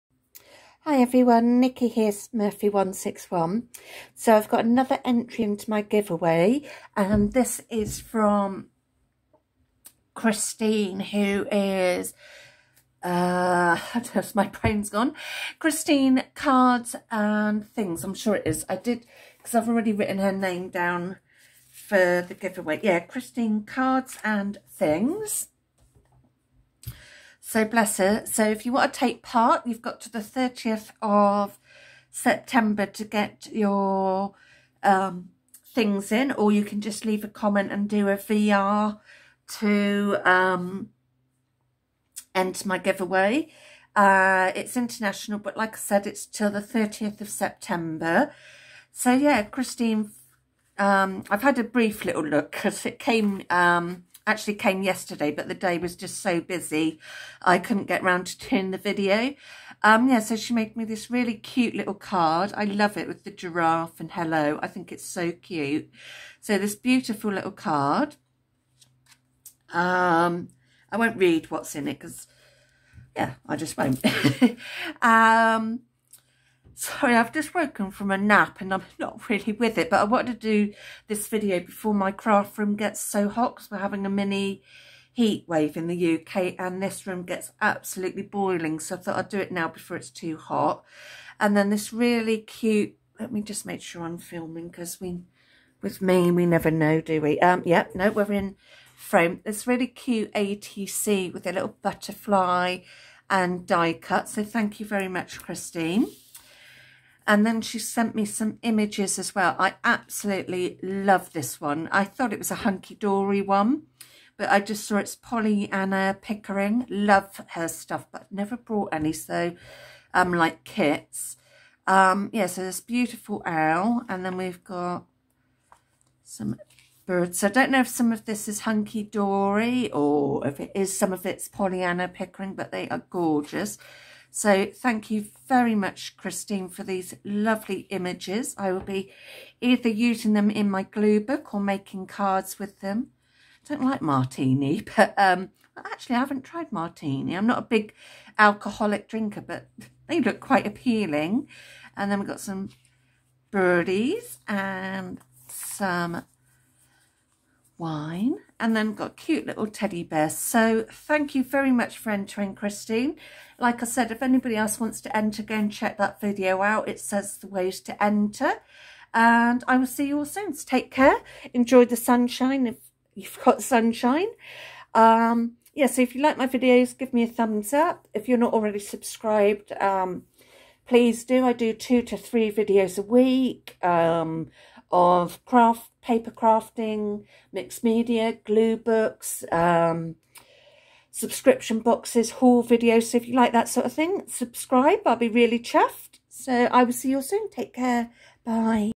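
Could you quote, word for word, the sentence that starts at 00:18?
I did, because I've already written her name down for the giveaway.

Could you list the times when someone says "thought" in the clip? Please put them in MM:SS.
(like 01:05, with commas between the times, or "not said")
01:28, 01:52.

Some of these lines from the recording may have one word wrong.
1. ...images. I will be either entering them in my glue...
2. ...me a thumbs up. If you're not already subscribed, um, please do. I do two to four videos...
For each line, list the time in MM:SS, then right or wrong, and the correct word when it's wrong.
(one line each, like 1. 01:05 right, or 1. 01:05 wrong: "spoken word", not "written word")
1. 02:17 wrong: "using", not "entering"
2. 02:57 wrong: "three", not "four".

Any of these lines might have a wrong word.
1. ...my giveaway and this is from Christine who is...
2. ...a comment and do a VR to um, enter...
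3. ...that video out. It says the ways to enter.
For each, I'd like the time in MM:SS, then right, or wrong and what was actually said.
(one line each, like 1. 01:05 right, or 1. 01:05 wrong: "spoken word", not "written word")
1. 00:05 right
2. 00:37 right
3. 02:45 right.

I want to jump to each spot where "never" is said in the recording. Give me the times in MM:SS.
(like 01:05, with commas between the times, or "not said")
01:36, 01:58.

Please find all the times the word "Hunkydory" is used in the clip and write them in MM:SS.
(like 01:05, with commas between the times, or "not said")
01:52, 02:08.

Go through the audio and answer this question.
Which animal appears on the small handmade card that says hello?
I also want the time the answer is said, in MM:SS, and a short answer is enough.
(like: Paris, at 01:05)
giraffe, at 01:03.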